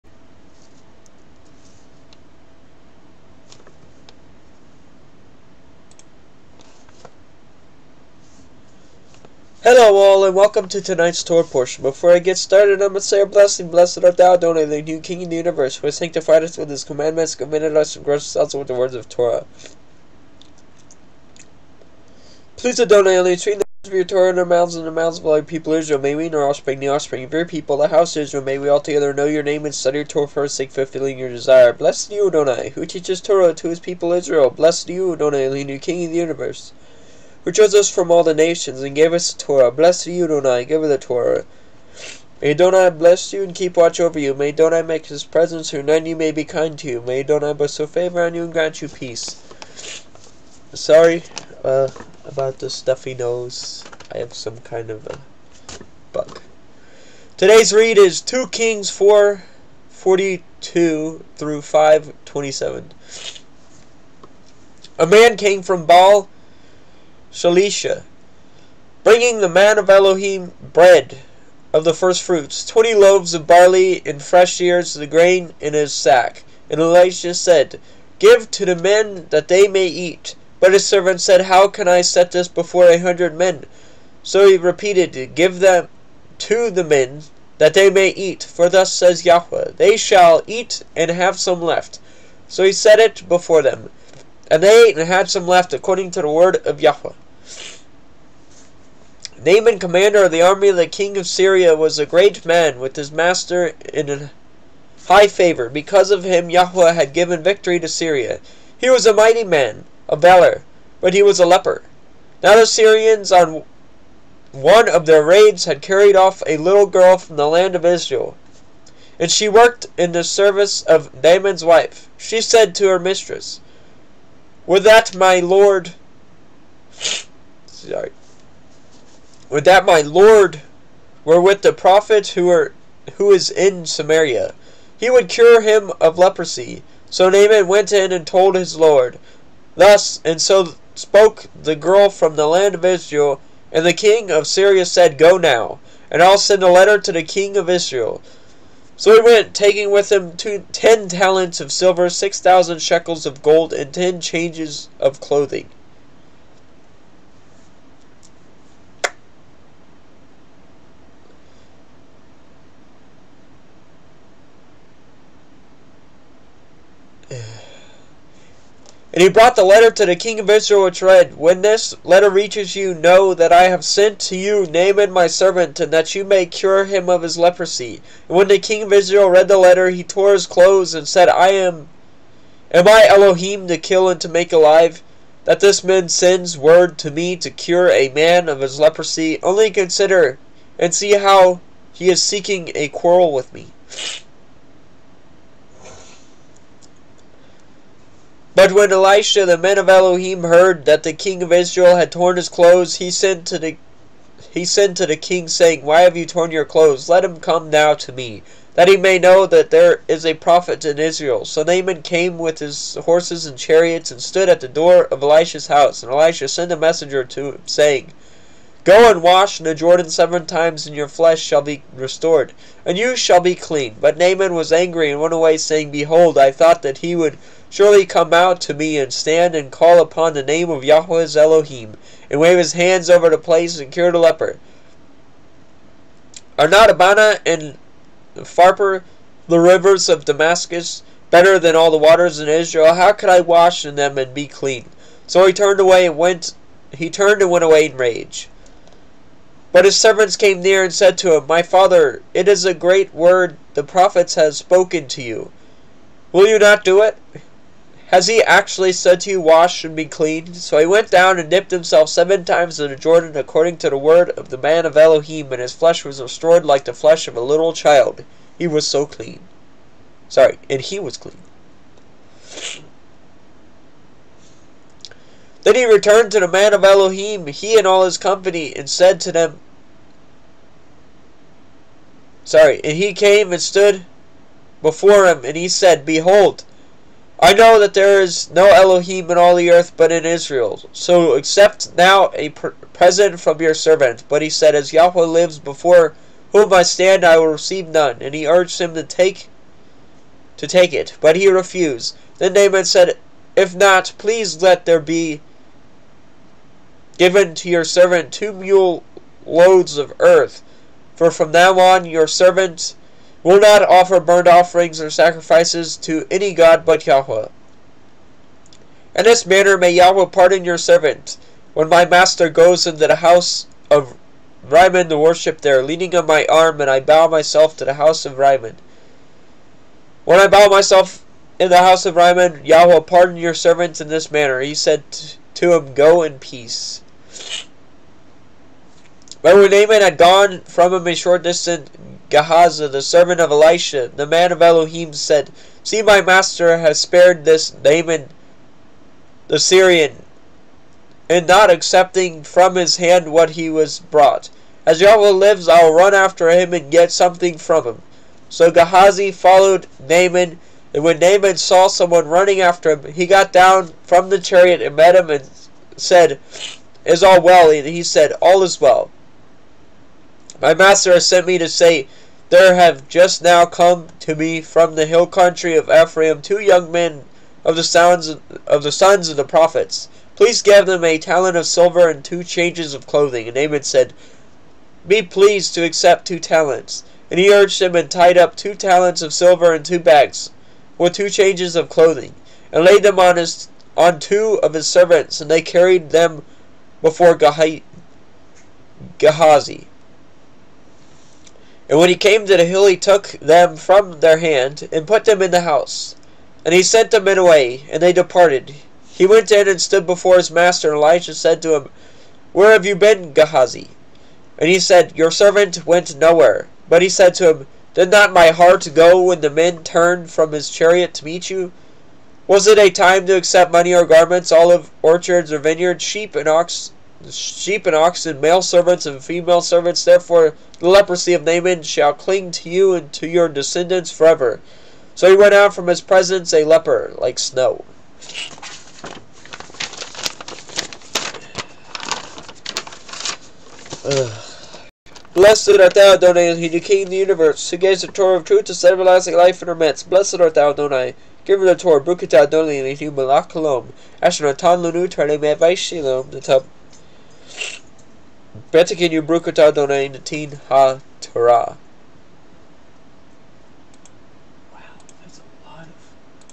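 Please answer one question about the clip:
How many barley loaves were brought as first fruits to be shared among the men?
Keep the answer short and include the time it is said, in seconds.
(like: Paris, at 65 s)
20, at 72 s.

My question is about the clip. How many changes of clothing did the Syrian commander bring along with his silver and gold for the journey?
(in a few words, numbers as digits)
10.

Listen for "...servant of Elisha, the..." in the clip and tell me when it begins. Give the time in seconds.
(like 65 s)
343 s.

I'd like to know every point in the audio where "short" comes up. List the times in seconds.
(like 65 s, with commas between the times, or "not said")
341 s.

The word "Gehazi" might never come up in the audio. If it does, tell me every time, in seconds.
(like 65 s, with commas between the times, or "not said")
342 s, 358 s, 397 s, 413 s.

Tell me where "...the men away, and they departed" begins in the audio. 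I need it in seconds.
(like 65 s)
407 s.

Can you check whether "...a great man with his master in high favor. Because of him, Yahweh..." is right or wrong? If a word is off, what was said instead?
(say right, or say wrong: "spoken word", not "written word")
right.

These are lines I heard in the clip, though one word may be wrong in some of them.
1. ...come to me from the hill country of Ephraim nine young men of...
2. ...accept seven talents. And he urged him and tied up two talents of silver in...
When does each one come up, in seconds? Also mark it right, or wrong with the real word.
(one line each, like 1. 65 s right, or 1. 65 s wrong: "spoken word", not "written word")
1. 373 s wrong: "two", not "nine"
2. 385 s wrong: "two", not "seven".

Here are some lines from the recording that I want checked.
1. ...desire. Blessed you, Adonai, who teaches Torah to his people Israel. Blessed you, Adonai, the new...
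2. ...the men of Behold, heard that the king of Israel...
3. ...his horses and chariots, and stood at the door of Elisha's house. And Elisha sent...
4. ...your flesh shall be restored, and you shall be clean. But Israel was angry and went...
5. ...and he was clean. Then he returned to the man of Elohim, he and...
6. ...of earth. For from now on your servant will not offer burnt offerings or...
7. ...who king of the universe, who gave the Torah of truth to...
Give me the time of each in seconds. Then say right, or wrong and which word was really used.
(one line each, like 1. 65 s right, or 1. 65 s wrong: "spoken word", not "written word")
1. 31 s right
2. 199 s wrong: "Elohim", not "Behold"
3. 212 s right
4. 220 s wrong: "Naaman", not "Israel"
5. 270 s right
6. 309 s right
7. 446 s right.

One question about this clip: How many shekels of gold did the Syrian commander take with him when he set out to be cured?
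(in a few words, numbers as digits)
6000.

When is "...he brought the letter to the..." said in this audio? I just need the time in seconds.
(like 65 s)
169 s.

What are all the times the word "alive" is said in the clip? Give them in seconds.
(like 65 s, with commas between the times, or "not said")
184 s.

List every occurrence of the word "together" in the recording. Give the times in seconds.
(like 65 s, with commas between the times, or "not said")
28 s.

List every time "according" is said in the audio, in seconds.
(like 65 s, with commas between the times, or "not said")
95 s, 263 s.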